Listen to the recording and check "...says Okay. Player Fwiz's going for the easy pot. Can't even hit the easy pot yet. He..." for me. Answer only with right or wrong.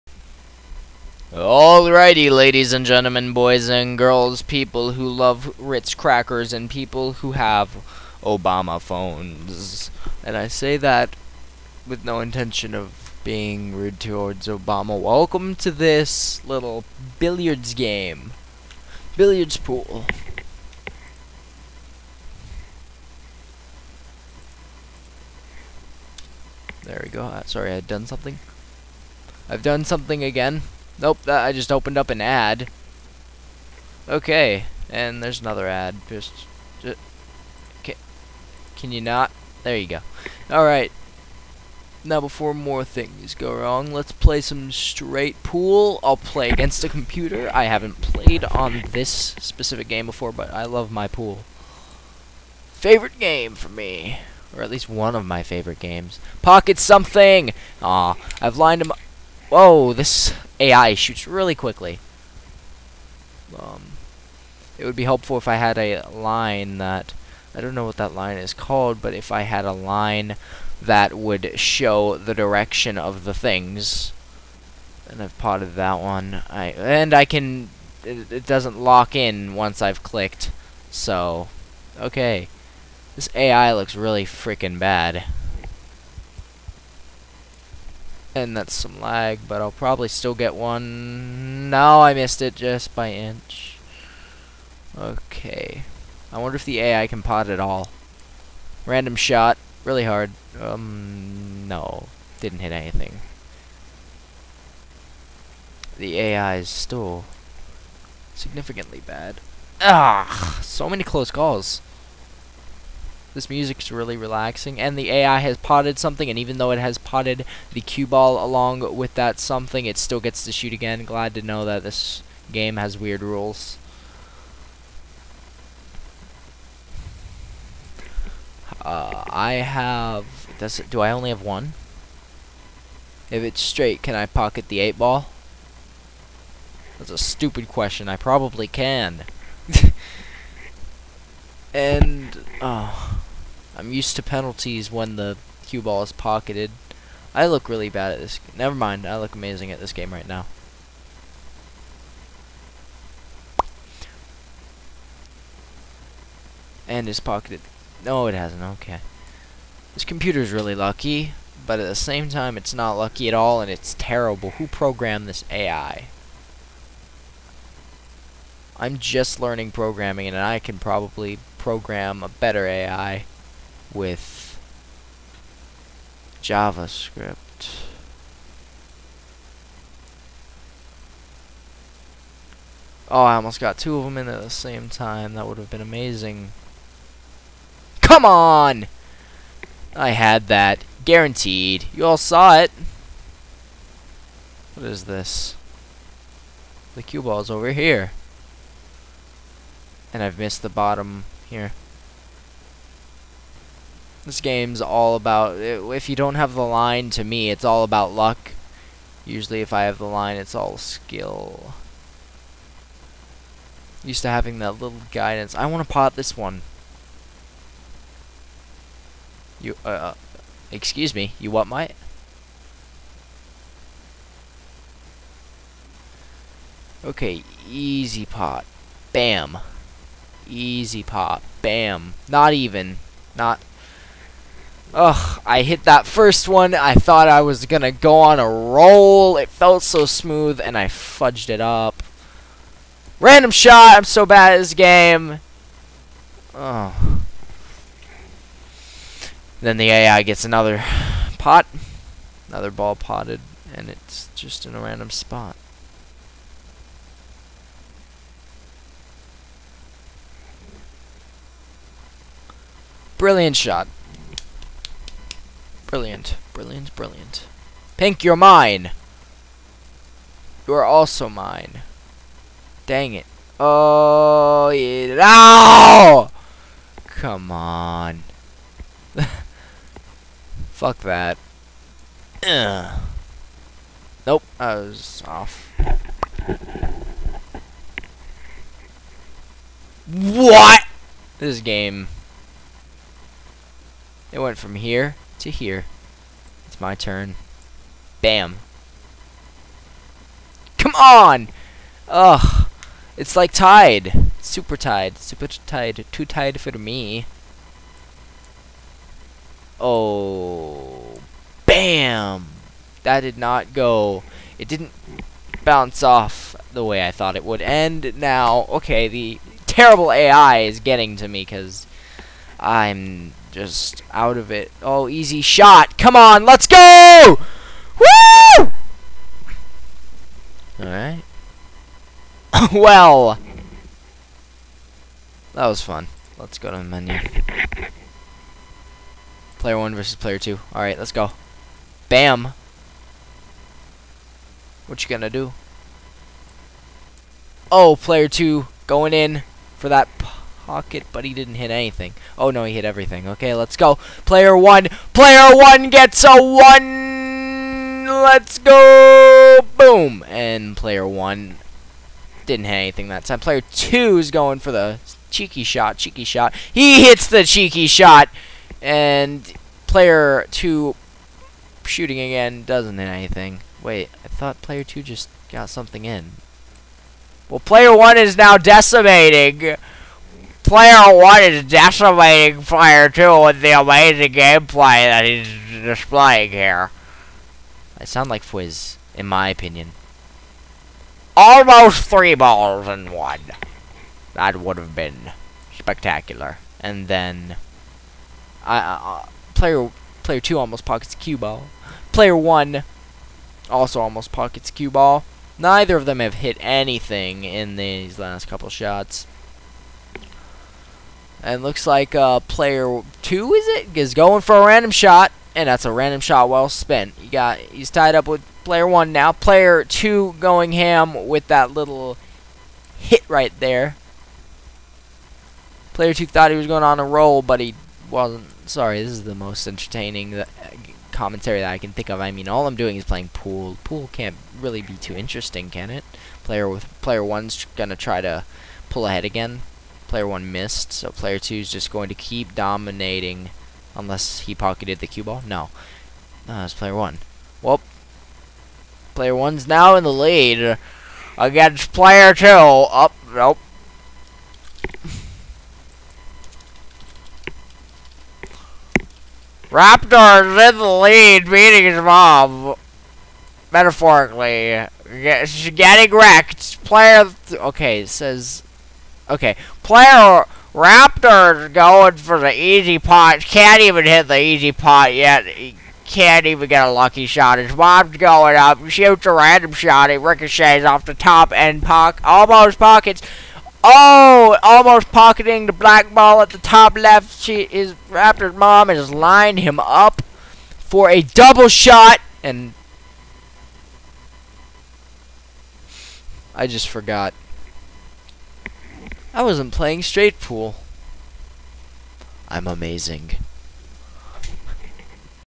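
wrong.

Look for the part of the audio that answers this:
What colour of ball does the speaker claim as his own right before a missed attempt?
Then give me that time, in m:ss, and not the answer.
4:27.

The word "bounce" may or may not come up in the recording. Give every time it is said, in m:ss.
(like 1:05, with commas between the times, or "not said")
5:15.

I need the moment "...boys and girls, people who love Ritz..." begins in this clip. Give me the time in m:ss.
0:03.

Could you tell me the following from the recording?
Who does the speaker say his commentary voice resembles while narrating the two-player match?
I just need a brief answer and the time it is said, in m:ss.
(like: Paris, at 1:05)
Fwiz, at 6:28.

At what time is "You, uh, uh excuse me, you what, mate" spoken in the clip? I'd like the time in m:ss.
3:39.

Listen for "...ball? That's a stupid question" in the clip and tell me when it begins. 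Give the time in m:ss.
2:14.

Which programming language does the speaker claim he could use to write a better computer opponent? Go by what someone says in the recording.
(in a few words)
JavaScript.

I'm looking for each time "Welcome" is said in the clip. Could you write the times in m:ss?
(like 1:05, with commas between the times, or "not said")
0:14.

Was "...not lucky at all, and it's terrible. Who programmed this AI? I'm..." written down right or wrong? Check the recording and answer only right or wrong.
right.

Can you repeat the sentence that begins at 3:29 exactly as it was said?
Usually if I have the line, it's all skill.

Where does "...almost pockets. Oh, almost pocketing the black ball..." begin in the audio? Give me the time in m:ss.
8:02.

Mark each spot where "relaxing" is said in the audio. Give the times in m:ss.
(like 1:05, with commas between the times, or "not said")
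1:54.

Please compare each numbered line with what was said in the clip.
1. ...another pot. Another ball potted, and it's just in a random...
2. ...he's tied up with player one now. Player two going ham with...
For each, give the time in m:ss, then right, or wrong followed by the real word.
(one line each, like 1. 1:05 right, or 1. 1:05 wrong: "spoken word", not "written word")
1. 4:10 right
2. 6:57 right.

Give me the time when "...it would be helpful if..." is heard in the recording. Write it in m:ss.
1:04.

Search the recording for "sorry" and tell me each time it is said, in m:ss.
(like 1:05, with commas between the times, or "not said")
0:27, 7:08.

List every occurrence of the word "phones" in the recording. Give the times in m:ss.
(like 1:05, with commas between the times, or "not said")
0:08.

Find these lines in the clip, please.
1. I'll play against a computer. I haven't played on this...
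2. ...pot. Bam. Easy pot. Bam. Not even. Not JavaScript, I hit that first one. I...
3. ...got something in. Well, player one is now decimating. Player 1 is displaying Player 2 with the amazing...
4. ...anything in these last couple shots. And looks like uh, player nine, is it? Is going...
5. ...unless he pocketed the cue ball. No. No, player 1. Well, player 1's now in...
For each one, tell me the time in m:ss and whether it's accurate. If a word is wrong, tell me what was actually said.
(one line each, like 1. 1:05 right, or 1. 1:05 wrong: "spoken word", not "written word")
1. 0:46 right
2. 3:48 wrong: "Ugh", not "JavaScript"
3. 6:15 wrong: "decimating", not "displaying"
4. 6:46 wrong: "two", not "nine"
5. 7:23 right.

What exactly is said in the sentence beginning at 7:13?
Pool can't really be too interesting, can it?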